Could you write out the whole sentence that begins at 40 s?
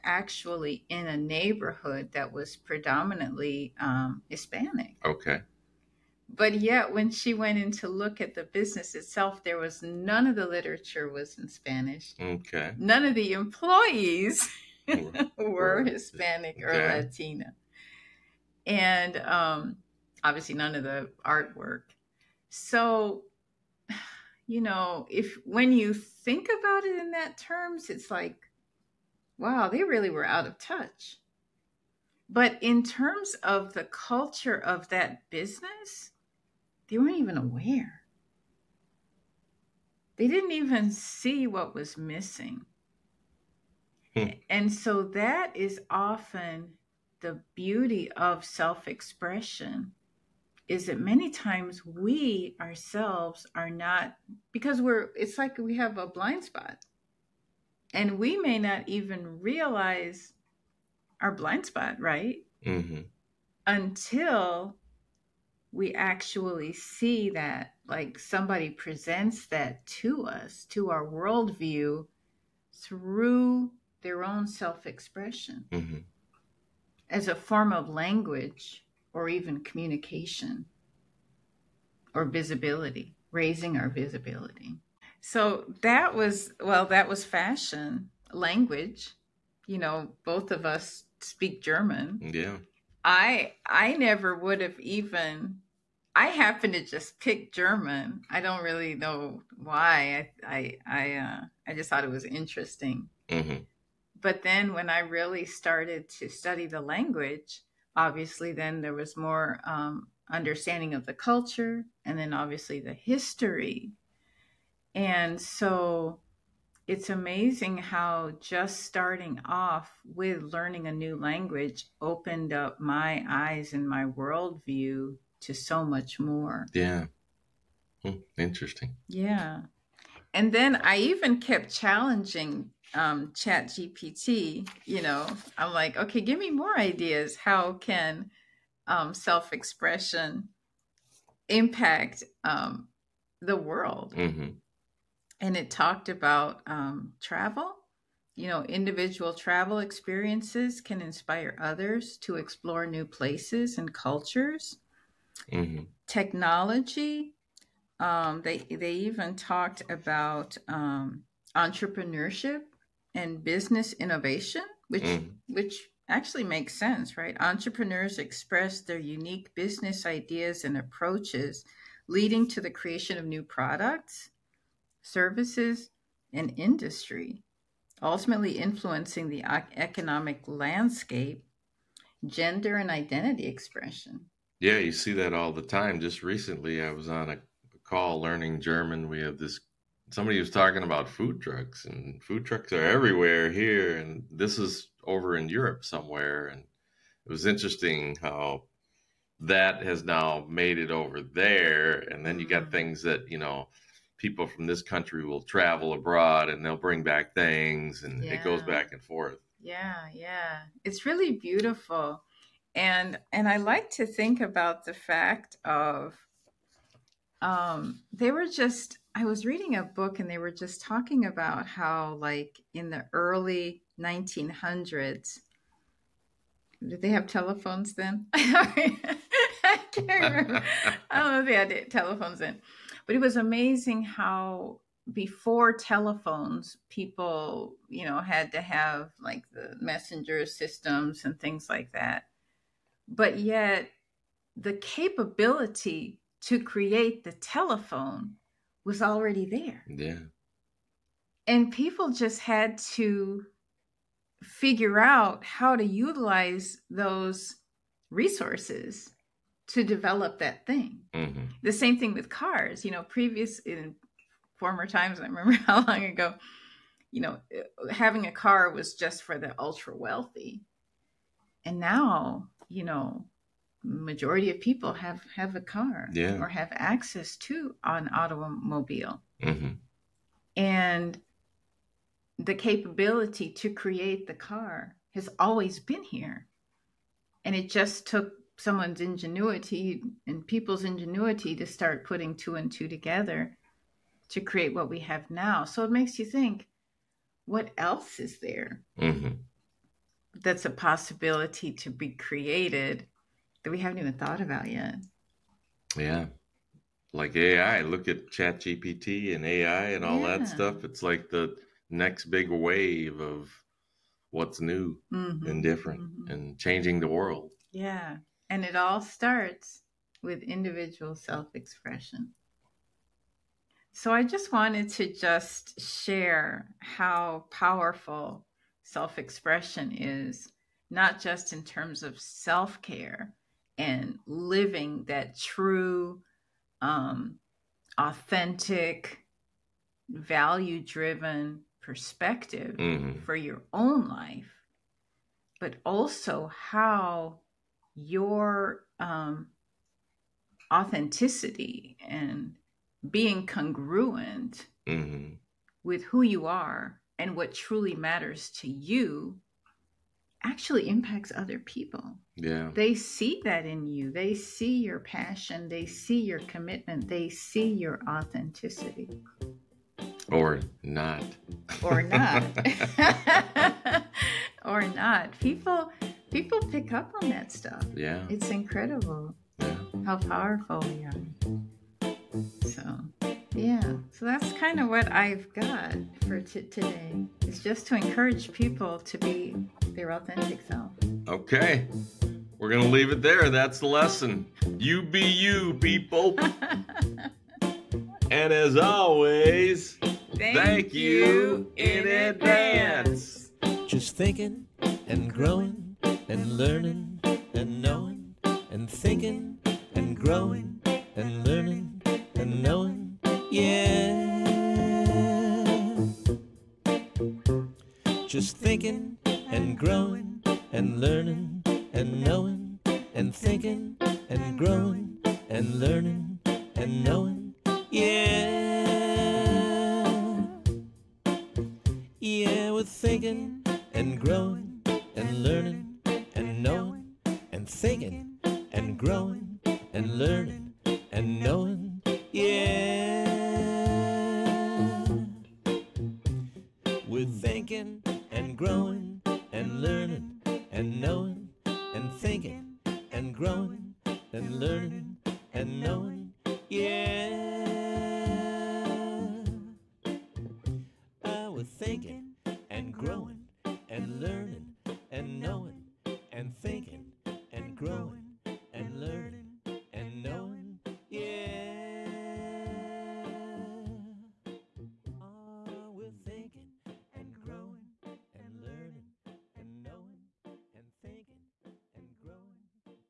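They didn't even see what was missing.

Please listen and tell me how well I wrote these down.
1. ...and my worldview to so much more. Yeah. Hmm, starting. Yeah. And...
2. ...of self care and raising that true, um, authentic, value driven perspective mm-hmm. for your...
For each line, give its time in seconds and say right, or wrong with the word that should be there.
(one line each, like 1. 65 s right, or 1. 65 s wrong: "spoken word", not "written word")
1. 123 s wrong: "interesting", not "starting"
2. 332 s wrong: "living", not "raising".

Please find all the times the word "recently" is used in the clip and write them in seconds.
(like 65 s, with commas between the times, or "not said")
186 s.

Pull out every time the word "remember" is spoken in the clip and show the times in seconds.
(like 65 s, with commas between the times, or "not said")
230 s, 265 s.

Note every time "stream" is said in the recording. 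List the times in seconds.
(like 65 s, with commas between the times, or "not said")
not said.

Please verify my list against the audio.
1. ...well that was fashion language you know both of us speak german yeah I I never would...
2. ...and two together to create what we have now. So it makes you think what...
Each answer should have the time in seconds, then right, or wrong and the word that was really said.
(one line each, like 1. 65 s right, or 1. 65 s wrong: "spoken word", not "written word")
1. 86 s right
2. 292 s right.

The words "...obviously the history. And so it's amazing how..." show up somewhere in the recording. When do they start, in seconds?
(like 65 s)
112 s.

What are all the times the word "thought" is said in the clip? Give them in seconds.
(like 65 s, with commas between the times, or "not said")
101 s, 304 s.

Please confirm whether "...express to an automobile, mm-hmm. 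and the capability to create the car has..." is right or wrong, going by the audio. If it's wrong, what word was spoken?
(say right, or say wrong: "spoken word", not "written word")
wrong: "access", not "express".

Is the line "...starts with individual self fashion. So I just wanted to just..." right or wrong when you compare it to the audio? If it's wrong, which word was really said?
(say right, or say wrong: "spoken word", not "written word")
wrong: "expression", not "fashion".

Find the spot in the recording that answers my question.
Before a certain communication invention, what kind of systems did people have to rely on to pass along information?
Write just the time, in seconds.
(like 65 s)
239 s.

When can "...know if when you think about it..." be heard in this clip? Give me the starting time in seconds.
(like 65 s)
24 s.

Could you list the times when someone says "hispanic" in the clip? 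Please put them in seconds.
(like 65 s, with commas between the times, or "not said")
4 s, 15 s.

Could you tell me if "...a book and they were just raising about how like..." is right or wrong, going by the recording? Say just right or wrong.
wrong.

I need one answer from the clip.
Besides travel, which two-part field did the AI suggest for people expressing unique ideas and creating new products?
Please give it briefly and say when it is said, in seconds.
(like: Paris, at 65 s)
entrepreneurship and business innovation, at 161 s.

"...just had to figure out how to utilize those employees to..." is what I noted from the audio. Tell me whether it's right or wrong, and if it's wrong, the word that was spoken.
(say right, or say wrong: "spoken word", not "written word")
wrong: "resources", not "employees".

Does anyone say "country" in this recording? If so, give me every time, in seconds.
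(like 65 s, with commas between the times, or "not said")
204 s.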